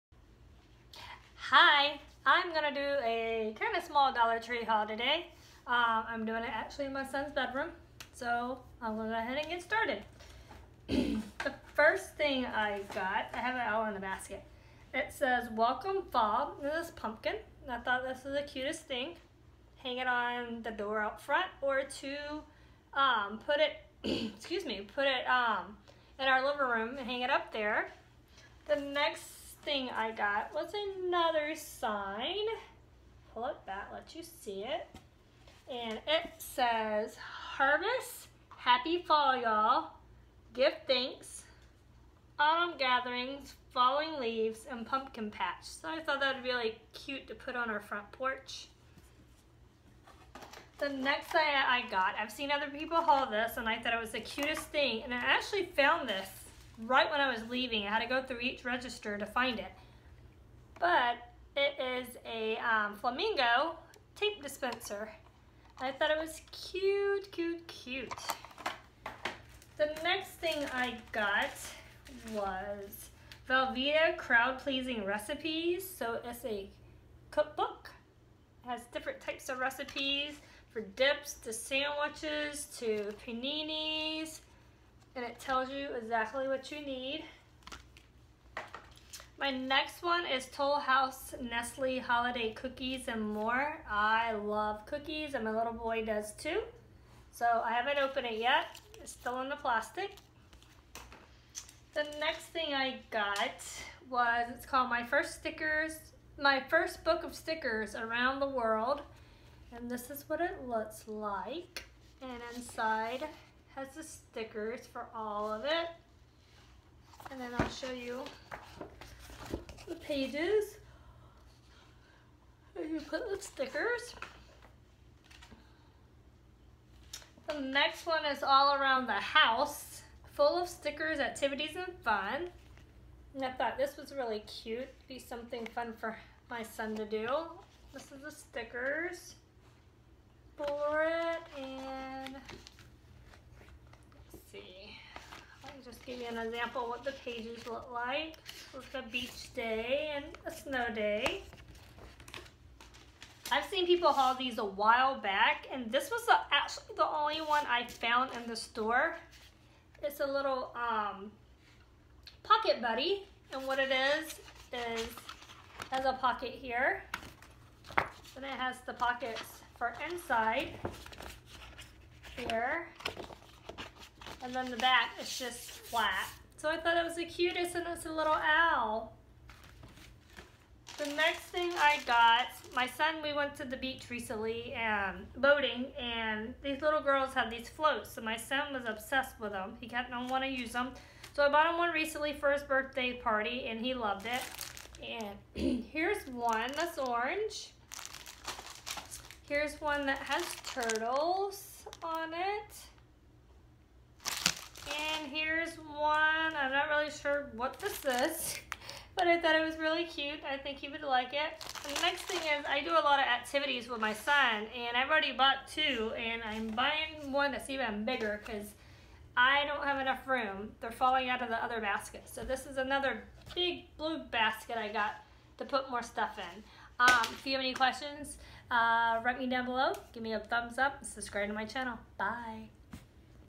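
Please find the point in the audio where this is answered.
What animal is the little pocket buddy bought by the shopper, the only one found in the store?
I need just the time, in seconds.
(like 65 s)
178 s.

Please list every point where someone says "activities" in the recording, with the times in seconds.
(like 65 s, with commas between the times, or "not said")
131 s, 213 s.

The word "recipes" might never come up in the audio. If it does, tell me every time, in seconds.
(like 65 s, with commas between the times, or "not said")
75 s, 79 s.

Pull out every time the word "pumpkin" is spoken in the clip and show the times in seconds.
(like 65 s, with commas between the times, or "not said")
16 s, 44 s.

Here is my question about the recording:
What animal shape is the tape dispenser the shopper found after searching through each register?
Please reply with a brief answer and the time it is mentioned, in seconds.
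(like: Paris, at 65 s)
Flamingo, at 62 s.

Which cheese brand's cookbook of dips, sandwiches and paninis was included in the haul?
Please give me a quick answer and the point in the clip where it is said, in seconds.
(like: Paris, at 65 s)
Velveeta, at 73 s.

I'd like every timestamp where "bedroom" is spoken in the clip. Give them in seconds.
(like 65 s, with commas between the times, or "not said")
7 s.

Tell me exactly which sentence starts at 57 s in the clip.
I had to go through each register to find it.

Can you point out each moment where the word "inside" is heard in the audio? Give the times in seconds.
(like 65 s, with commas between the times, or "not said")
112 s, 170 s.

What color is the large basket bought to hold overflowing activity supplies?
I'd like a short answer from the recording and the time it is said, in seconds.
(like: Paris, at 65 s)
Blue, at 223 s.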